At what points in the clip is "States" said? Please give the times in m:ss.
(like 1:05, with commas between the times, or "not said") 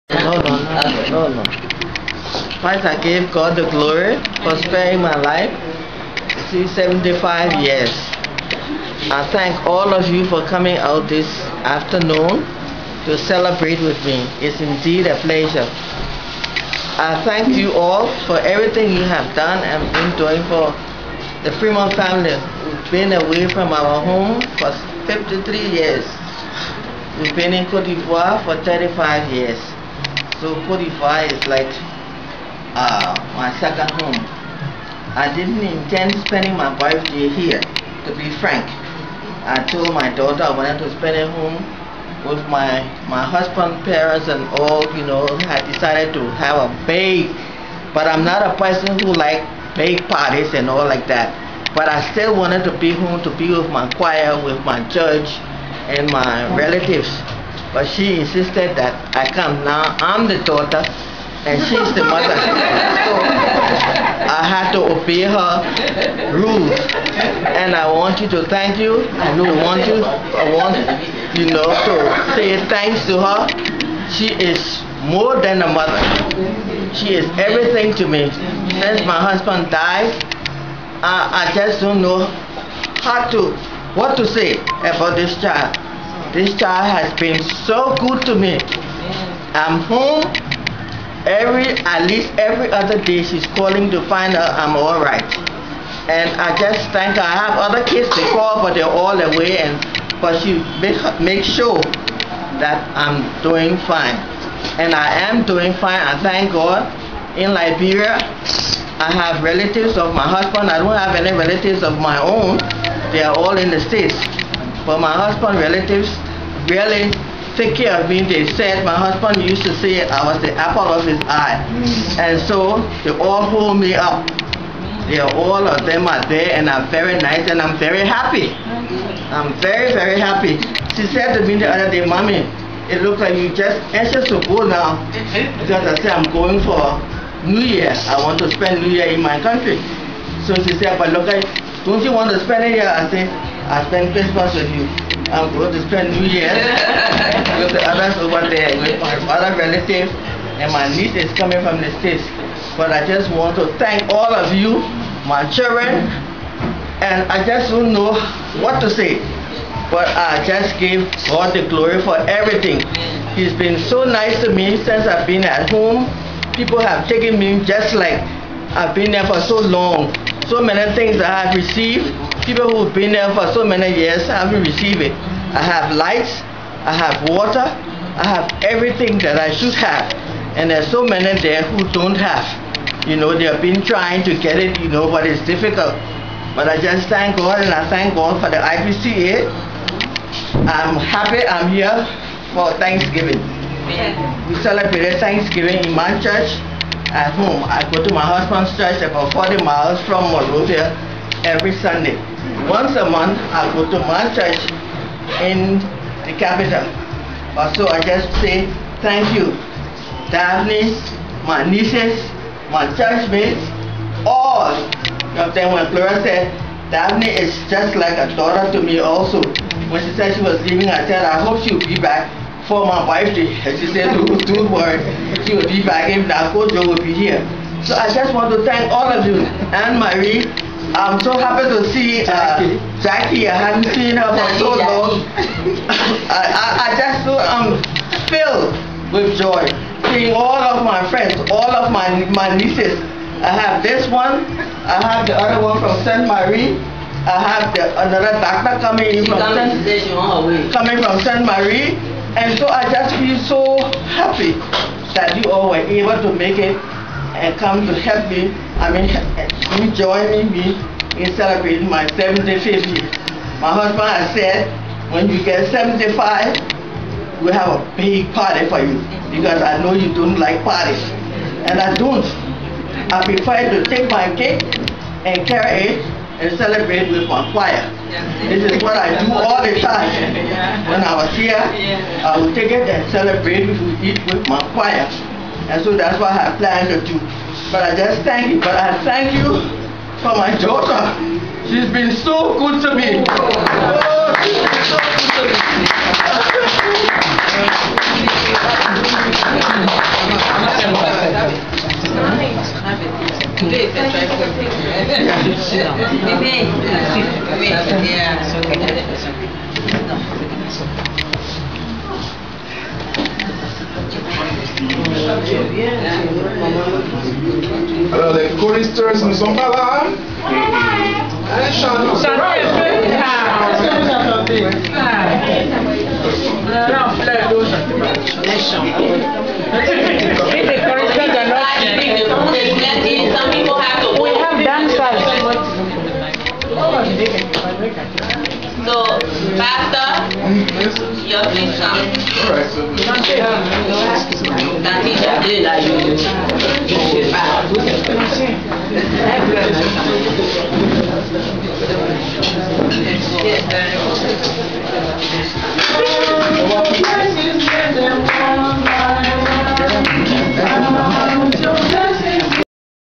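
1:53, 2:32.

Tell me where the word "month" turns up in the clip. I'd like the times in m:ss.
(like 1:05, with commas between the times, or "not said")
3:23.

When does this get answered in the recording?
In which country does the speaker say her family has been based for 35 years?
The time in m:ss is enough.
0:27.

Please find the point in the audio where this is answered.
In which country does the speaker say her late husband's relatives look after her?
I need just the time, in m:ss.
1:47.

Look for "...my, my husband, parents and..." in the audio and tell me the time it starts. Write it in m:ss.
0:42.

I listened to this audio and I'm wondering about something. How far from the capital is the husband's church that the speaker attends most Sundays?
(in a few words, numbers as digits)
40 miles.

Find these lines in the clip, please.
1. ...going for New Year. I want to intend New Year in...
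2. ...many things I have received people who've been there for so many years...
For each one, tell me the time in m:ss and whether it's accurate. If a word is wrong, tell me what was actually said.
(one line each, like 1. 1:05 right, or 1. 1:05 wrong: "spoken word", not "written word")
1. 2:16 wrong: "spend", not "intend"
2. 2:50 right.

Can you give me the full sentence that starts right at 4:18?
I mean, you join me in celebrating my 75th year.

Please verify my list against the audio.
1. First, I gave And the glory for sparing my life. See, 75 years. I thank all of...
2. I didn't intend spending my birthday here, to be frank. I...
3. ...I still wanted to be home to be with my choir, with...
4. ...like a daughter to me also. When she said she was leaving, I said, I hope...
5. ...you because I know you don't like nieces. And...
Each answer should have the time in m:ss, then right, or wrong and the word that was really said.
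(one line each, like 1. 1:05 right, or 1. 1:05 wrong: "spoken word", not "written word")
1. 0:02 wrong: "God", not "And"
2. 0:35 right
3. 0:51 right
4. 3:37 right
5. 4:28 wrong: "parties", not "nieces".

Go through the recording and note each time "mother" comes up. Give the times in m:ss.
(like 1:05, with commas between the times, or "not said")
1:02, 1:15.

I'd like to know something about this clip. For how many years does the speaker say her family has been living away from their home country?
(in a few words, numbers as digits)
53.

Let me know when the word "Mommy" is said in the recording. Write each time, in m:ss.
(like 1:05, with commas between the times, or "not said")
2:12.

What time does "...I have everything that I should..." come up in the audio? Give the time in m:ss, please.
2:57.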